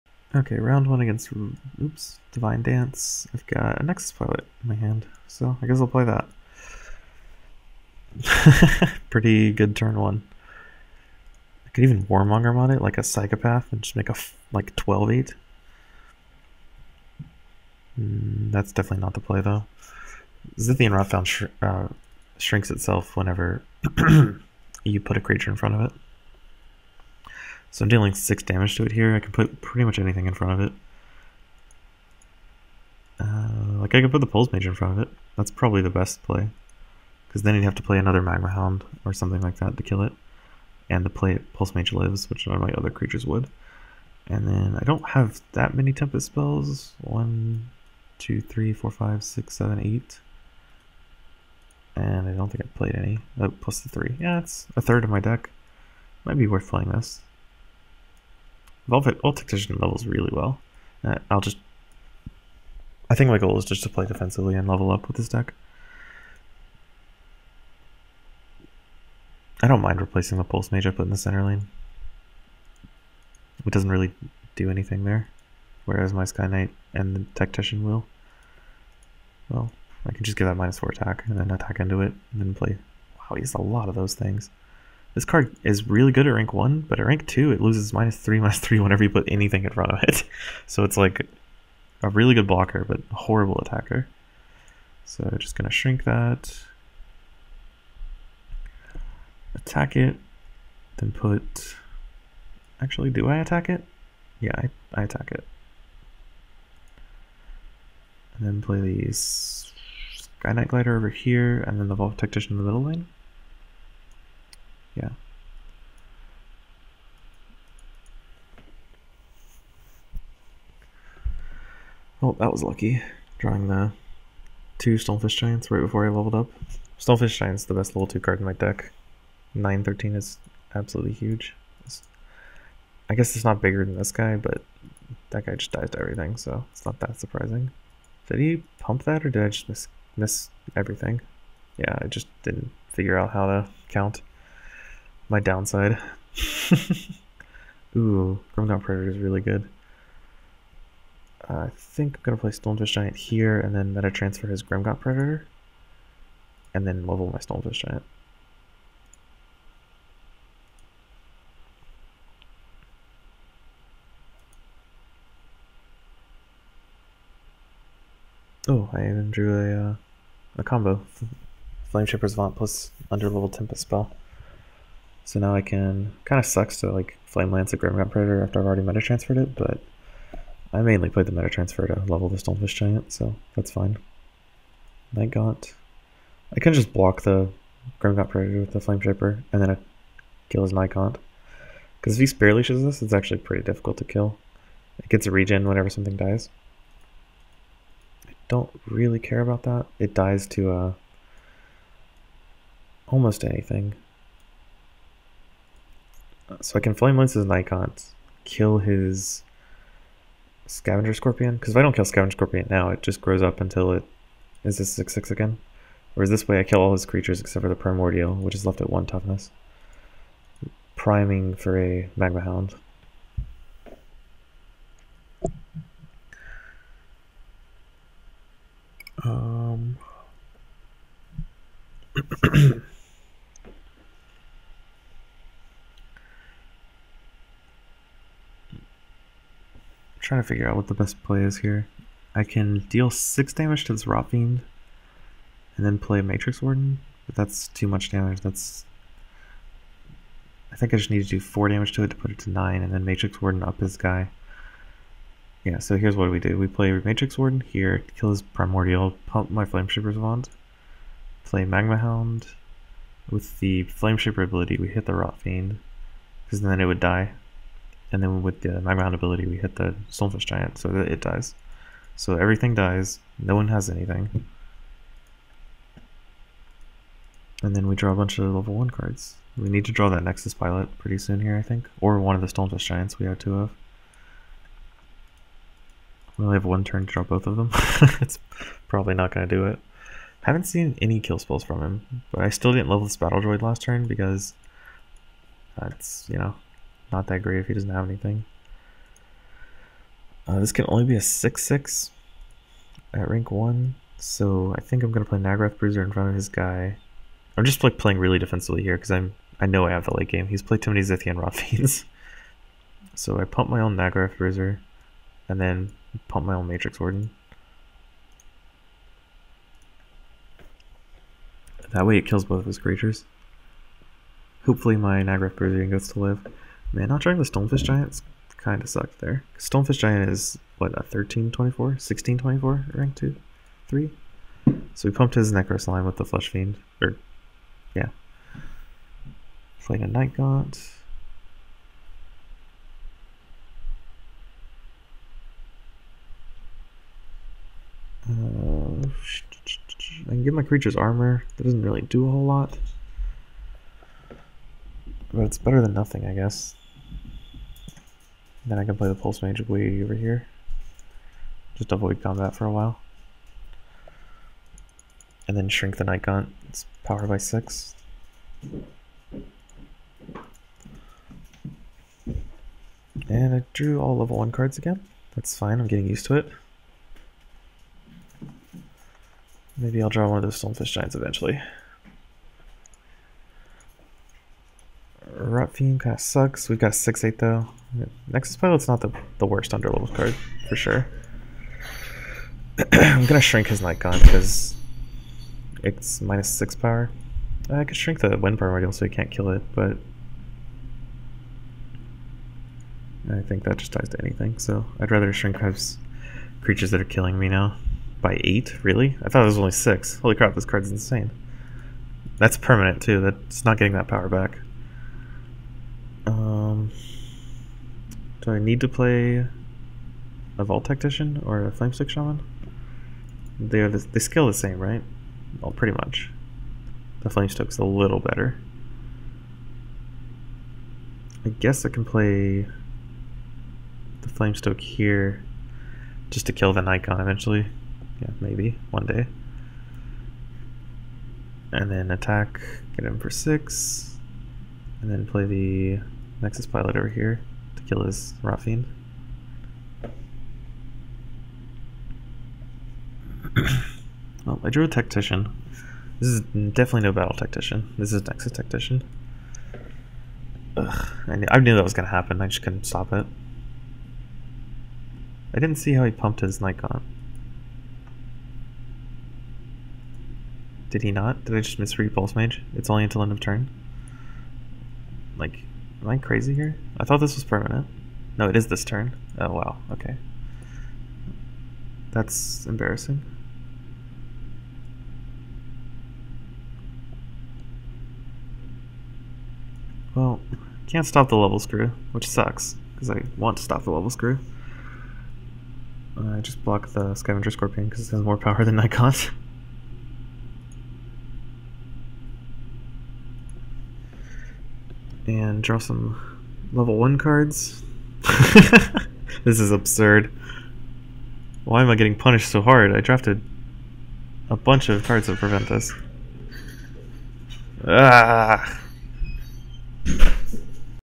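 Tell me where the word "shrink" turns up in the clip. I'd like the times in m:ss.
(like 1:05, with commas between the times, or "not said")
0:22, 1:35, 6:05, 6:33, 6:37, 6:45.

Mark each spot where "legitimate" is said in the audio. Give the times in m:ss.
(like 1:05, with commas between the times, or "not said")
not said.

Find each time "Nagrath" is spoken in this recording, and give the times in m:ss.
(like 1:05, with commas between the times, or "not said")
5:05, 5:13, 5:25.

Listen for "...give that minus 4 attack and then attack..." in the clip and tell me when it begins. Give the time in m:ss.
1:20.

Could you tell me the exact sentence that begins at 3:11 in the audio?
Because if he Spear Leashes this, it's actually pretty difficult to kill.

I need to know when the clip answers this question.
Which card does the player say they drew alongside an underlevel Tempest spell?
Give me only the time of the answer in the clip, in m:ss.
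2:51.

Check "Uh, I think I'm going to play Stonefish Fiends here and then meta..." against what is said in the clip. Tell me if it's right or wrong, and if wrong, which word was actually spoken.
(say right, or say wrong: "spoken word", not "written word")
wrong: "Giant", not "Fiends".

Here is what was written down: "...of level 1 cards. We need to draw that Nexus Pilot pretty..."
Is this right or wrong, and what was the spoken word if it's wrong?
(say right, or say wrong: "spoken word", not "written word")
right.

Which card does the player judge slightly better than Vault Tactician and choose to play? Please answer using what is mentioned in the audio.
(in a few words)
Flamestoke Shaman.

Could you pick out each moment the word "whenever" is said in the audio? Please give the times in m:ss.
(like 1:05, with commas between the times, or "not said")
0:23, 1:28, 3:15.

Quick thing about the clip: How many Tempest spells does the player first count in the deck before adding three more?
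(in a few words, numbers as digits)
8.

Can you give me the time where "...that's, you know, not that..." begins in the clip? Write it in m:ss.
4:55.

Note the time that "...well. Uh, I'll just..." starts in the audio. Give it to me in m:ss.
1:00.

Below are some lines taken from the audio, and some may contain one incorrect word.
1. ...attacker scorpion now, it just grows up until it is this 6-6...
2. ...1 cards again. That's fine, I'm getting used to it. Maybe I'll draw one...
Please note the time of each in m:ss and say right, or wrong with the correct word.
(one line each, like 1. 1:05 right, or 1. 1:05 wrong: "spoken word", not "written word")
1. 3:32 wrong: "scavenger", not "attacker"
2. 6:14 right.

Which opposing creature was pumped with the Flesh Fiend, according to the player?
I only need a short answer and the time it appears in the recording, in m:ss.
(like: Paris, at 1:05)
Necro Slime, at 5:35.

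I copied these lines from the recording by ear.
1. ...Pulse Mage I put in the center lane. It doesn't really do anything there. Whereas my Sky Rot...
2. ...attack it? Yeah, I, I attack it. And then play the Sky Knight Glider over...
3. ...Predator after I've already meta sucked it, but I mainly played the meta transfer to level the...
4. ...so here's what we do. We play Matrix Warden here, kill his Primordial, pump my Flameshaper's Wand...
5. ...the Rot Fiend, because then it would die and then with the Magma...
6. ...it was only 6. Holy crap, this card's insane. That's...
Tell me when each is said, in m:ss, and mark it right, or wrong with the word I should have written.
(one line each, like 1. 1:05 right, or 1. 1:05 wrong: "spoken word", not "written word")
1. 1:10 wrong: "Knight", not "Rot"
2. 1:43 right
3. 2:58 wrong: "transferred", not "sucked"
4. 4:15 right
5. 4:25 right
6. 6:49 right.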